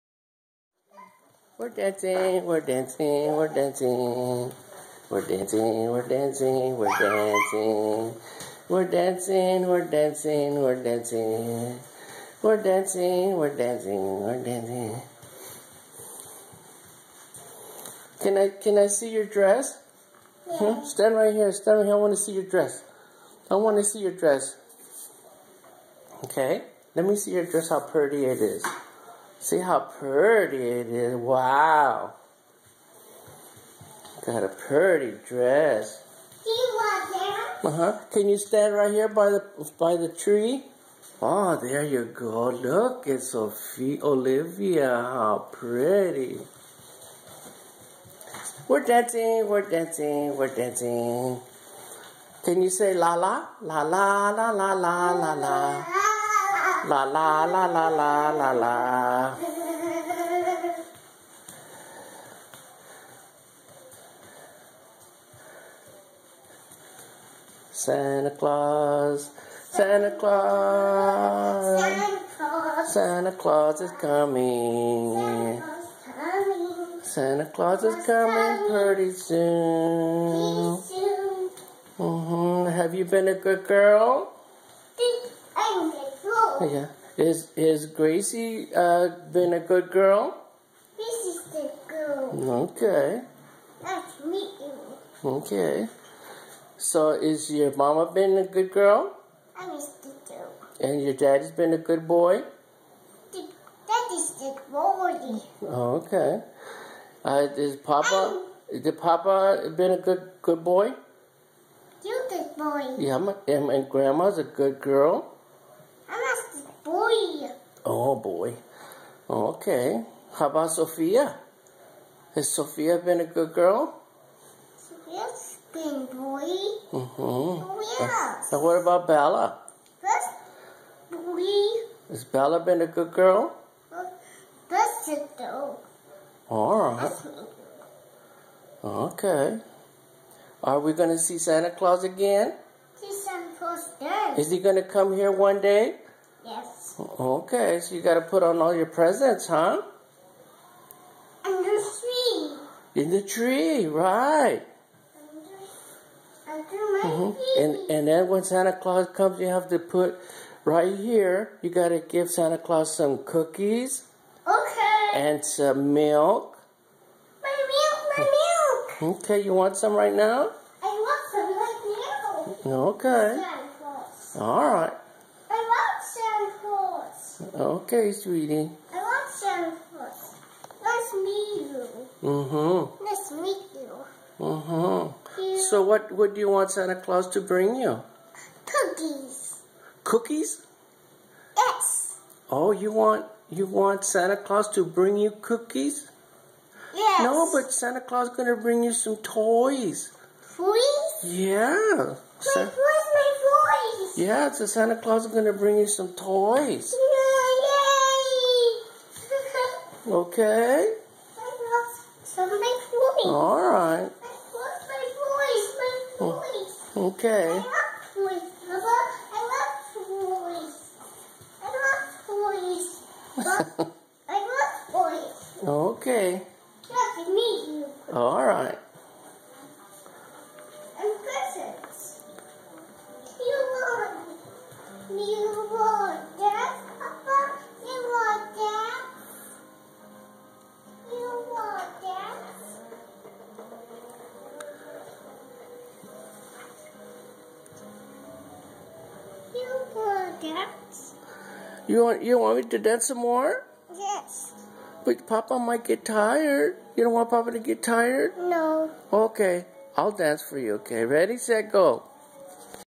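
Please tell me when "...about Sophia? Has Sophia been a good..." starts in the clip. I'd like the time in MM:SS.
02:00.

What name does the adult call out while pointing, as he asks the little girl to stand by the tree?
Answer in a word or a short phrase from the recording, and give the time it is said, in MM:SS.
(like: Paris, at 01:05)
Sophie Olivia, at 00:43.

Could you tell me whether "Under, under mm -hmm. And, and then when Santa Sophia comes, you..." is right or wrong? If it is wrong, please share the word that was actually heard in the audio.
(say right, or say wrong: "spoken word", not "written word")
wrong: "Claus", not "Sophia".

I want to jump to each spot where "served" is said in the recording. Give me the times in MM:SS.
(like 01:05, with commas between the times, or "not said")
not said.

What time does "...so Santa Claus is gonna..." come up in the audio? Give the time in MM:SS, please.
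03:24.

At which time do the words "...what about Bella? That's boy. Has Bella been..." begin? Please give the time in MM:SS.
02:08.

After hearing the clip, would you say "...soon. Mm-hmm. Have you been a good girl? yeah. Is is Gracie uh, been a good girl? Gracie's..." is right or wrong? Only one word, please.
right.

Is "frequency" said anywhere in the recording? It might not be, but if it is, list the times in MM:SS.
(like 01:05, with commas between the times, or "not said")
not said.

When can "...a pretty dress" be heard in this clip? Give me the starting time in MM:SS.
00:34.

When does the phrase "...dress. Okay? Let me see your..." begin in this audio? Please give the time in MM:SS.
00:24.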